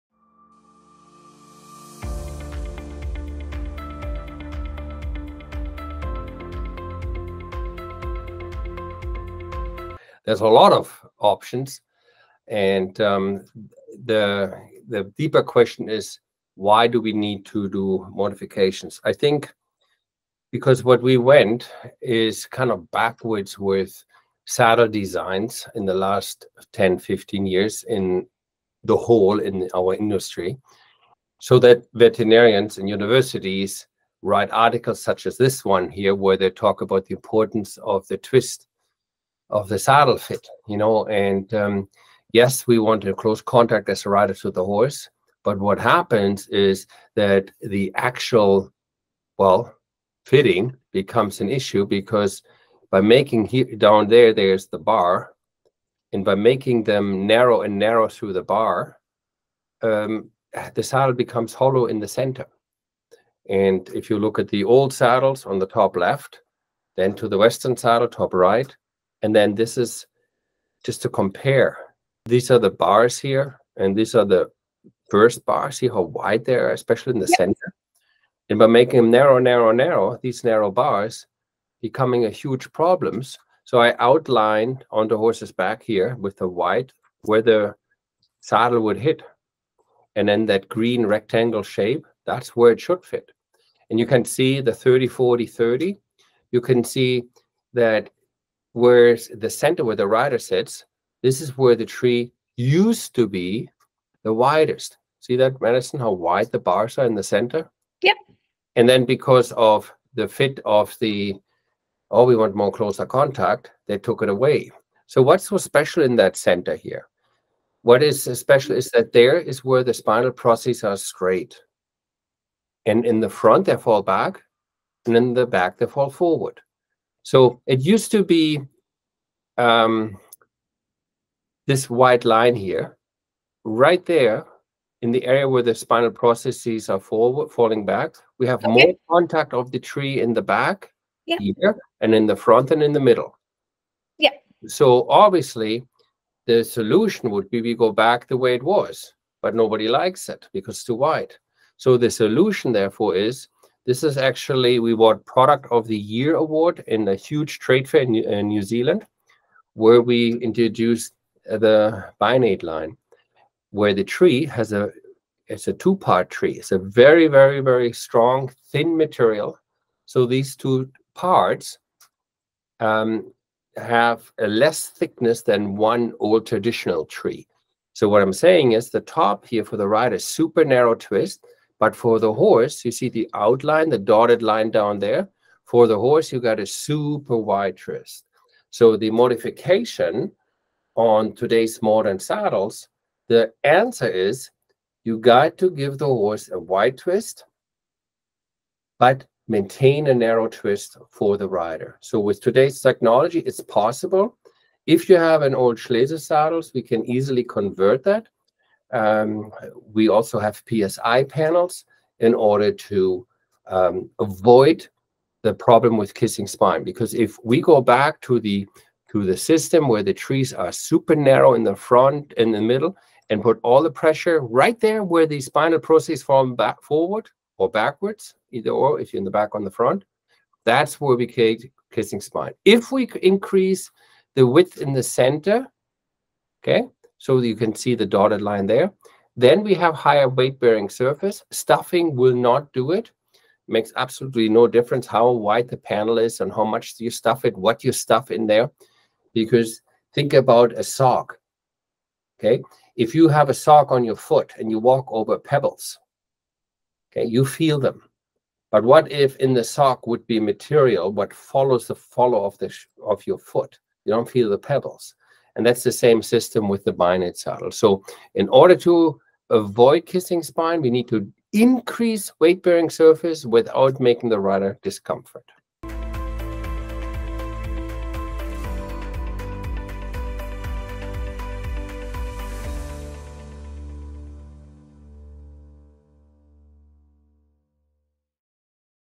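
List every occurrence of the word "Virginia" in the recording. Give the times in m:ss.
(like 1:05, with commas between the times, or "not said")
not said.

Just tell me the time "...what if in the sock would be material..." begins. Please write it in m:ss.
4:18.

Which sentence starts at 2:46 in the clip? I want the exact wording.
It's a very, very, very strong, thin material.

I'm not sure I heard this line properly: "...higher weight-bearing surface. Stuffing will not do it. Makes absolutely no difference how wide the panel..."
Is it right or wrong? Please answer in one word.
right.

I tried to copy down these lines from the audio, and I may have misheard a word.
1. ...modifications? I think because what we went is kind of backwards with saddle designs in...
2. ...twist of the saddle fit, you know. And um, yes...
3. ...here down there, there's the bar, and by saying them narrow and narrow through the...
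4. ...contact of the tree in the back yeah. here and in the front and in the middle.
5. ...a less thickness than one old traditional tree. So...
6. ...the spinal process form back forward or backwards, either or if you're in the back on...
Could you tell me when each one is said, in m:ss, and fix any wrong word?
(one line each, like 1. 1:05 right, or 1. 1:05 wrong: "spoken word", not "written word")
1. 0:18 right
2. 0:38 right
3. 0:53 wrong: "making", not "saying"
4. 2:19 right
5. 2:54 right
6. 3:45 right.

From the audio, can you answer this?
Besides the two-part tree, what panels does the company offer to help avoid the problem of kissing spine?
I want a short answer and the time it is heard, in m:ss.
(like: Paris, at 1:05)
PSI panels, at 3:30.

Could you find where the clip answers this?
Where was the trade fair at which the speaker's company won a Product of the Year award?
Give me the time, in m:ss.
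2:38.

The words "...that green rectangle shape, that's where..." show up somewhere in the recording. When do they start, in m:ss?
1:30.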